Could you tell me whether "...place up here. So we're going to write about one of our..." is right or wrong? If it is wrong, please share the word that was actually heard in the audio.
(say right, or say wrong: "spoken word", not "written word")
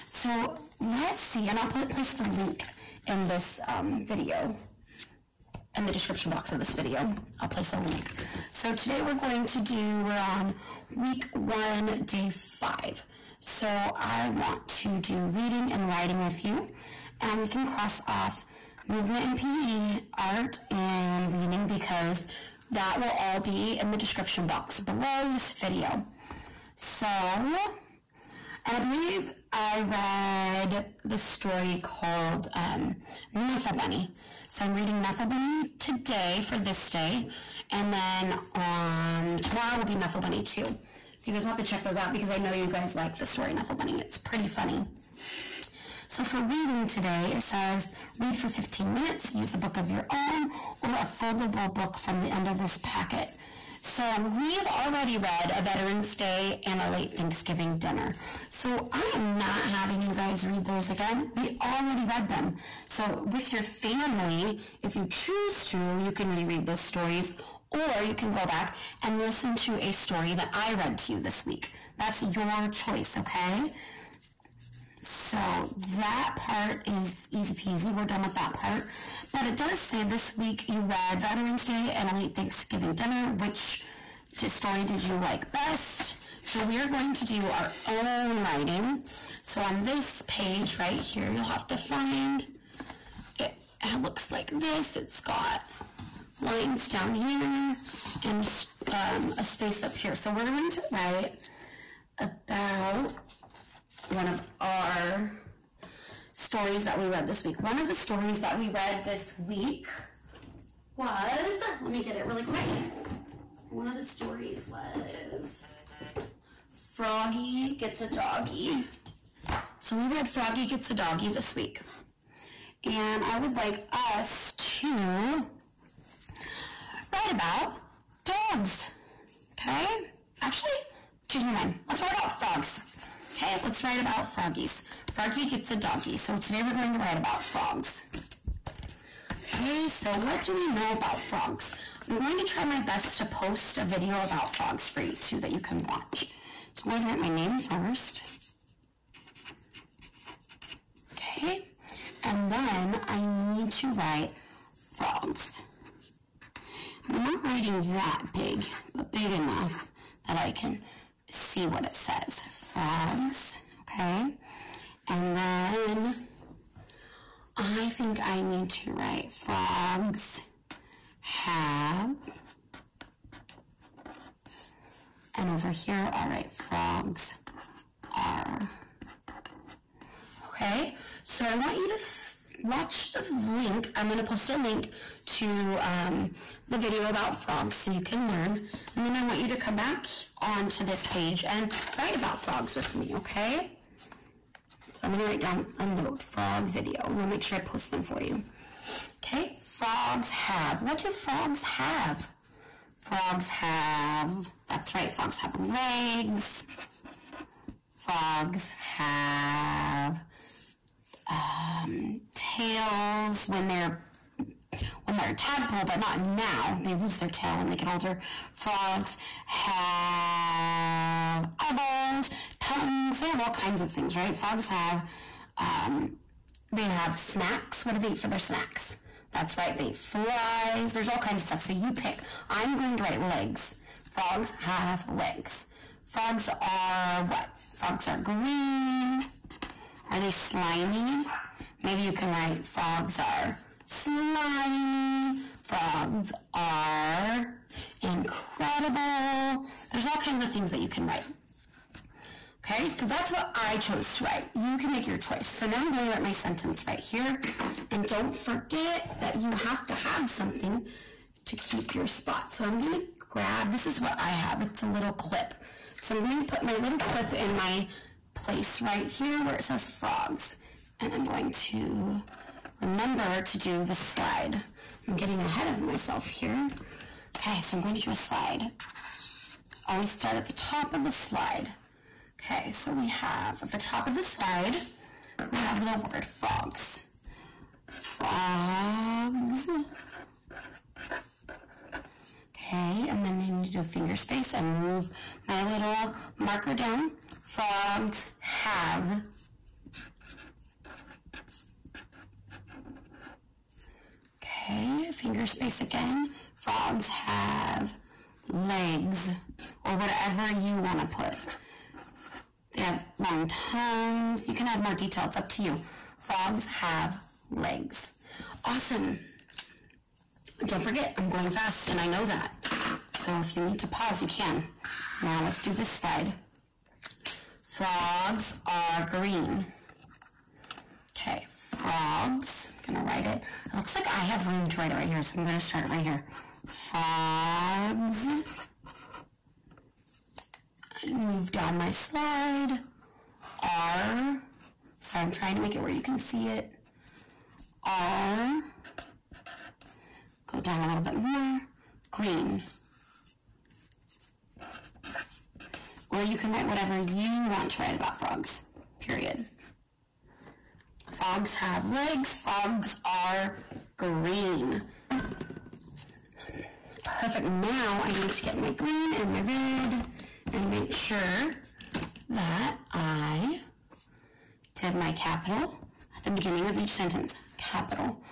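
wrong: "space", not "place".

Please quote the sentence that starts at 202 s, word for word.
Frogs have, that's right, frogs have legs.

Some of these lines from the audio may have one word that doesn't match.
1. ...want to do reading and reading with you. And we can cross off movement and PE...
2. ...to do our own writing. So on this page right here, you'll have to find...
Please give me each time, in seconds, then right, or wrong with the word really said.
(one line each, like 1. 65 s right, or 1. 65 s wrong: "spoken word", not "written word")
1. 14 s wrong: "writing", not "reading"
2. 87 s right.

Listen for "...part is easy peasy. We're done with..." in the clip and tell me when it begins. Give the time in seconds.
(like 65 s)
76 s.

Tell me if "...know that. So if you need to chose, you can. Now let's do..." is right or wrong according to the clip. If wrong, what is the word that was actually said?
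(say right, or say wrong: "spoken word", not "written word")
wrong: "pause", not "chose".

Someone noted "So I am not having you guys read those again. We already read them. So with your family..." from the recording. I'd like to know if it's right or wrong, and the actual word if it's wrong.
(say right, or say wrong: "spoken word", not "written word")
right.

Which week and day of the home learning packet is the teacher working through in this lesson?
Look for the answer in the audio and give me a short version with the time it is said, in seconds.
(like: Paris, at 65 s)
week one, day five, at 10 s.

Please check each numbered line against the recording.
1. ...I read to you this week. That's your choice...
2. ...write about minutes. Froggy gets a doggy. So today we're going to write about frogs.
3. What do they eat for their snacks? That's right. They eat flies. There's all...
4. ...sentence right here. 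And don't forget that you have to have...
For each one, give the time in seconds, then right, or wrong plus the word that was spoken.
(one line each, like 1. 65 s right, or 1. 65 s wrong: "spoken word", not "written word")
1. 70 s right
2. 133 s wrong: "froggies", not "minutes"
3. 227 s right
4. 256 s right.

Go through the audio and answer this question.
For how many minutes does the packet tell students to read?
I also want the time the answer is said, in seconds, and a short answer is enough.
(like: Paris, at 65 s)
15, at 48 s.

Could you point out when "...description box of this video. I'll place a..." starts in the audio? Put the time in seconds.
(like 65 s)
5 s.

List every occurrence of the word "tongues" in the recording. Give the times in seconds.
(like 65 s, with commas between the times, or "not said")
222 s, 313 s.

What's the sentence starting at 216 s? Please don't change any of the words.
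They lose their tail when they get older.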